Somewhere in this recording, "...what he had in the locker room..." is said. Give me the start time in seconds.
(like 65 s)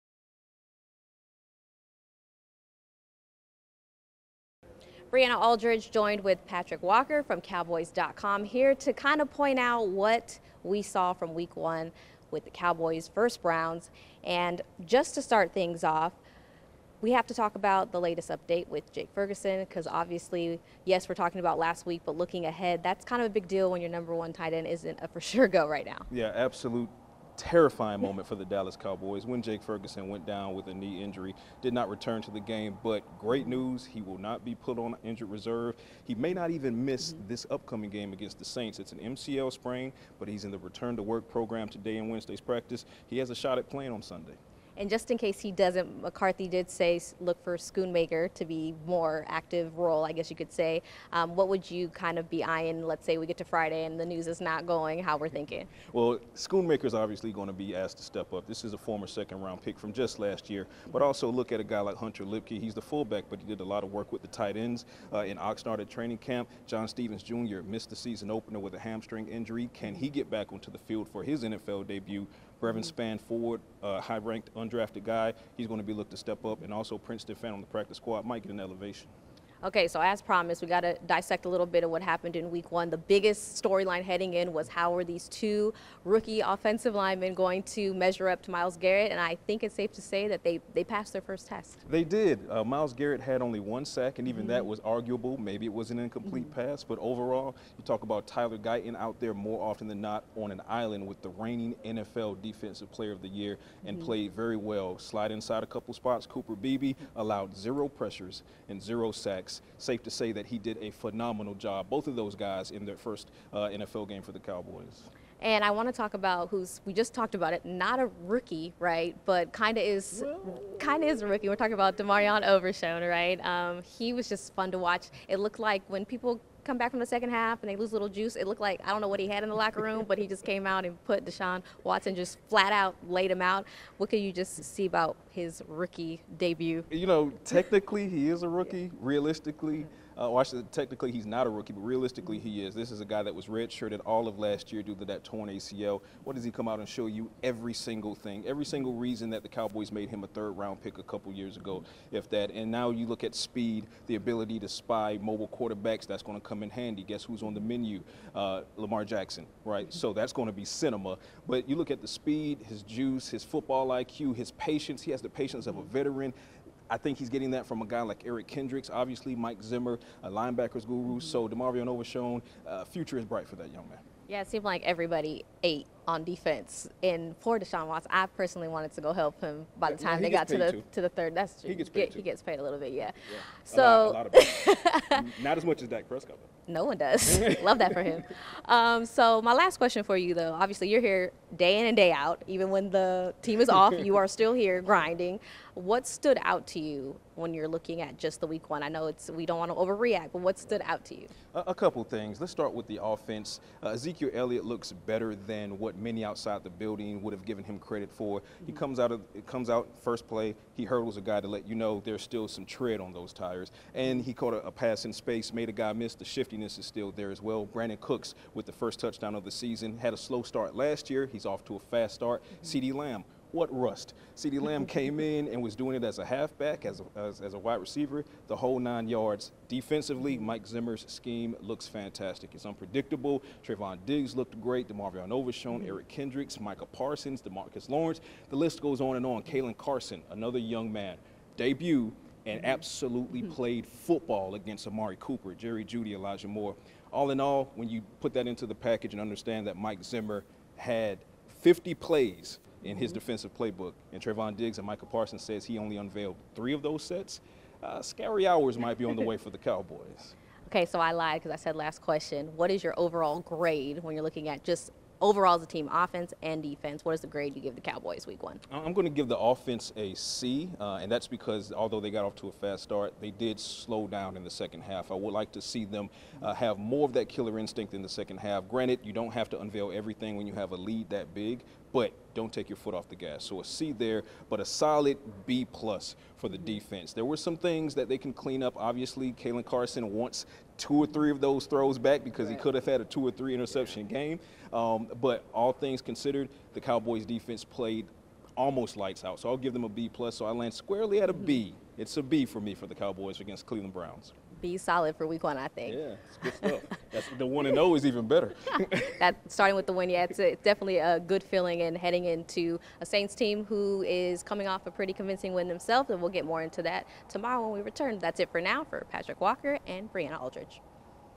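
129 s.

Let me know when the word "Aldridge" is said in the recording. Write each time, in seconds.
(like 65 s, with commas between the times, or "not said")
5 s, 320 s.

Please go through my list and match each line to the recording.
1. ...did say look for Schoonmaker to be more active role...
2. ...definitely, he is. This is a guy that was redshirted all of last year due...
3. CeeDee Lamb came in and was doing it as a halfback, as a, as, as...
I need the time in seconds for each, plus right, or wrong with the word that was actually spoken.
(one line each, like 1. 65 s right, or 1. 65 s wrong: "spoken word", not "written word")
1. 46 s right
2. 141 s wrong: "realistically", not "definitely"
3. 224 s right.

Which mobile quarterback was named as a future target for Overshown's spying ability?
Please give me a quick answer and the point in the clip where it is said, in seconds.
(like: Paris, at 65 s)
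Lamar Jackson, at 158 s.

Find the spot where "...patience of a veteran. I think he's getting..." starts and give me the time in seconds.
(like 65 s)
165 s.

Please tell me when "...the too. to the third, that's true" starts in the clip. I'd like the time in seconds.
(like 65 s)
180 s.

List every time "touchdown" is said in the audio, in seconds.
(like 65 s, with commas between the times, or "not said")
218 s.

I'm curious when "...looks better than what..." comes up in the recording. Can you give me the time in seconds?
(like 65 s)
204 s.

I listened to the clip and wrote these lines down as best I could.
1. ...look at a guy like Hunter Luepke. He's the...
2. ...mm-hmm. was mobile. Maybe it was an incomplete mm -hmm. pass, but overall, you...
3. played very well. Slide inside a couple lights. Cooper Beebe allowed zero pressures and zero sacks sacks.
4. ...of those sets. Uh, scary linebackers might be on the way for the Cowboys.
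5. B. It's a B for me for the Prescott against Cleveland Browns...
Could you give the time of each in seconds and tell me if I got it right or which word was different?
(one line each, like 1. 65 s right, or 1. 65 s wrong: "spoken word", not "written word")
1. 61 s right
2. 94 s wrong: "arguable", not "mobile"
3. 104 s wrong: "spots", not "lights"
4. 256 s wrong: "hours", not "linebackers"
5. 301 s wrong: "Cowboys", not "Prescott".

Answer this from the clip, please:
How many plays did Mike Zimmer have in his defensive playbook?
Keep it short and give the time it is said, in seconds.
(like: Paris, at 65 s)
50, at 251 s.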